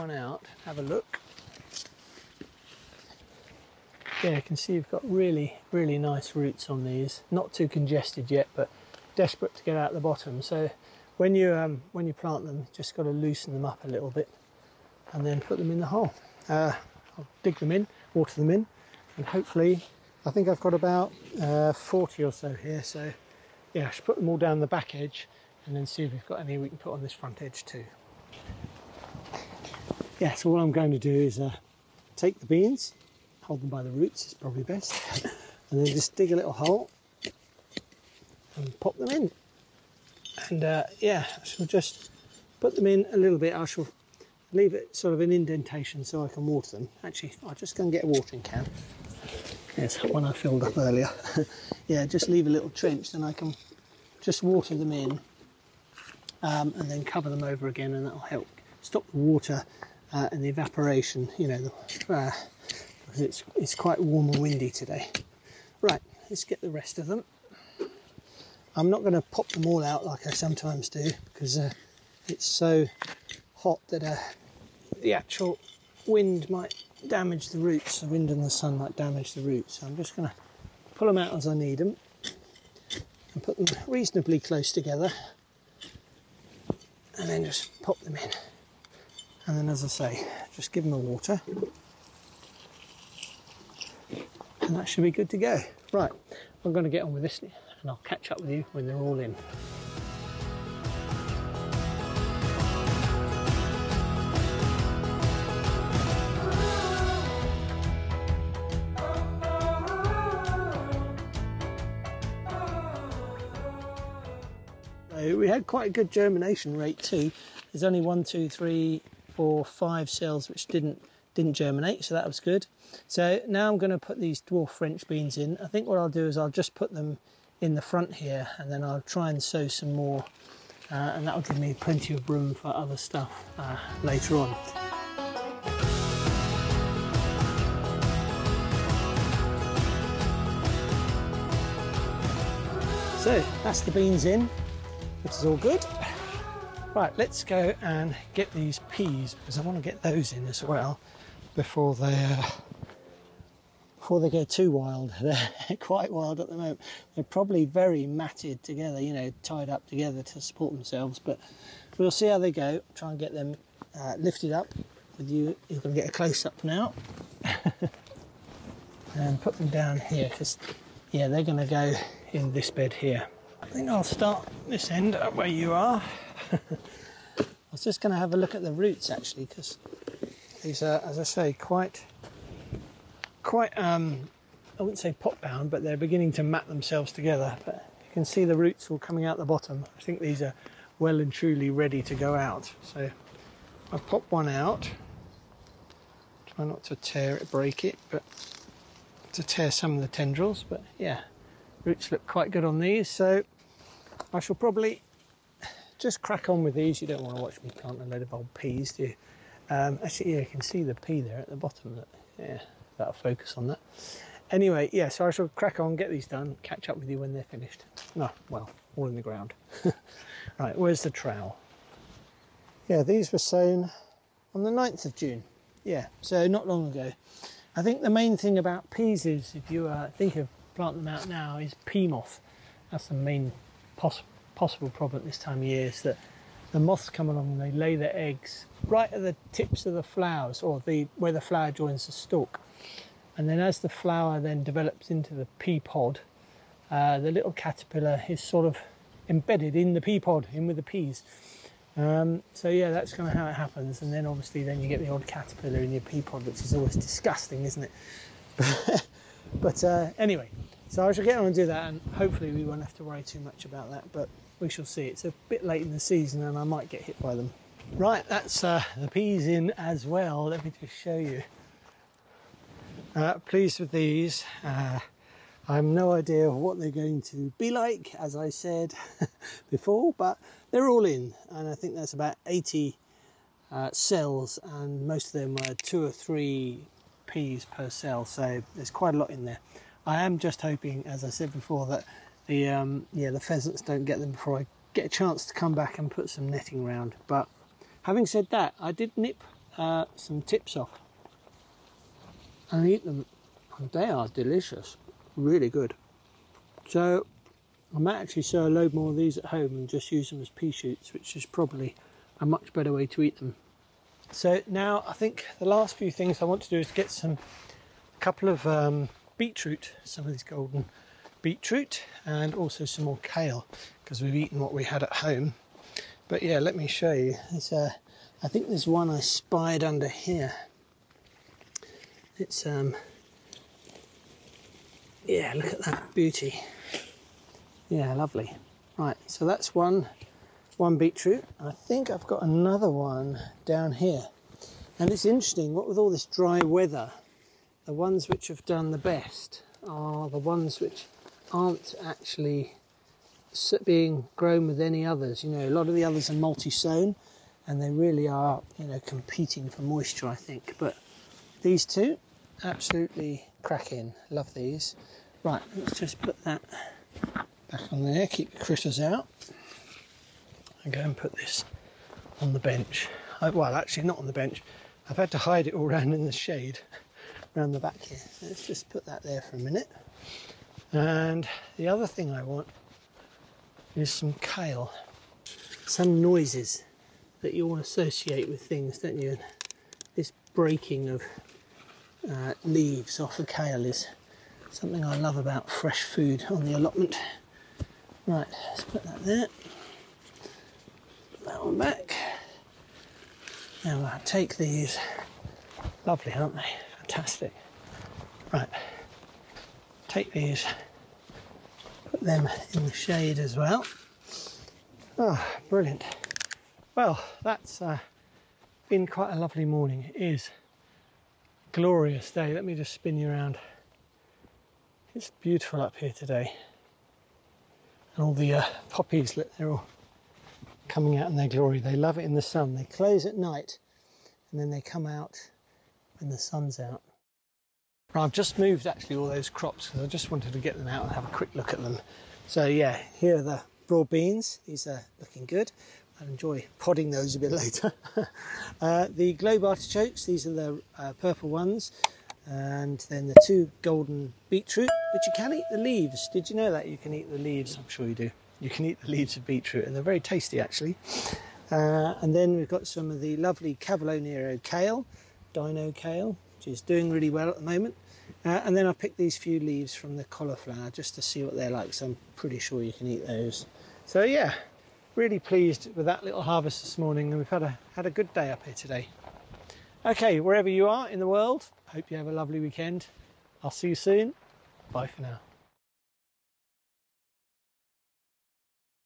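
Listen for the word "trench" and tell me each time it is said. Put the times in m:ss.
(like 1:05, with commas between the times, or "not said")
0:52.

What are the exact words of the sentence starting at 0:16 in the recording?
Uh, I'll dig them in, water them in, and hopefully, I think I've got about uh, 40 or so here.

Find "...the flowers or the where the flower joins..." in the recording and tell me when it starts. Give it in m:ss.
3:59.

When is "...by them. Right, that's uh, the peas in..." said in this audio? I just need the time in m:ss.
4:27.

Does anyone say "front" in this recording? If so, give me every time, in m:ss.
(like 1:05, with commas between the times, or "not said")
0:27, 2:07.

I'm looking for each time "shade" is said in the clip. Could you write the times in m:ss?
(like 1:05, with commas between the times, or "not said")
6:16, 6:52.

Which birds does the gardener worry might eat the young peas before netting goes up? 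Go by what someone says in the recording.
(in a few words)
Pheasants.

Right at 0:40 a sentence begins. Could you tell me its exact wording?
And uh, yeah, I shall just put them in a little bit.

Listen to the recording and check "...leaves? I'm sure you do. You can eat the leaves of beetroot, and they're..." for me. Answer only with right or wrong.
right.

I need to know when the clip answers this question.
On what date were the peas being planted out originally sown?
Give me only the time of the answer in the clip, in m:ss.
3:44.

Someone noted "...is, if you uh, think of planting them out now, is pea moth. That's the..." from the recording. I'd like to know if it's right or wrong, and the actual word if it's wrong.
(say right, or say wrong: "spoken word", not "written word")
right.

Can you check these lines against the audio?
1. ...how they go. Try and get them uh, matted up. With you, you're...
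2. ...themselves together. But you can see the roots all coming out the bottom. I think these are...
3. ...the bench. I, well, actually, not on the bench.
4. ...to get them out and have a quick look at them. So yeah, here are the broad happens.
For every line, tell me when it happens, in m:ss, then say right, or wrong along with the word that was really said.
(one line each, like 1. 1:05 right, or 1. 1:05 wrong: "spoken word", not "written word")
1. 2:42 wrong: "lifted", not "matted"
2. 3:06 right
3. 6:12 right
4. 7:20 wrong: "beans", not "happens".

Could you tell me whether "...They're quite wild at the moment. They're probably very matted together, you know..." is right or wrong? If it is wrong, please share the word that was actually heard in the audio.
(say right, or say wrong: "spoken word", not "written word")
right.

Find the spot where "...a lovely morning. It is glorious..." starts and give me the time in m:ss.
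6:59.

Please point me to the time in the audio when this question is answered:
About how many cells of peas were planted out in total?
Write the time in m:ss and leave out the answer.
4:42.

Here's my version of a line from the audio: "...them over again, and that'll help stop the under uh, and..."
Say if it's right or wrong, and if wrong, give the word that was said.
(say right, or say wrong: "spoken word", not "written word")
wrong: "water", not "under".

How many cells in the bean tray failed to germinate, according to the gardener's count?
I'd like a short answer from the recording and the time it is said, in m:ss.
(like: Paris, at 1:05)
5, at 1:59.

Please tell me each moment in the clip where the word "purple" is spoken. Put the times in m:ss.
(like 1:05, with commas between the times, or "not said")
7:31.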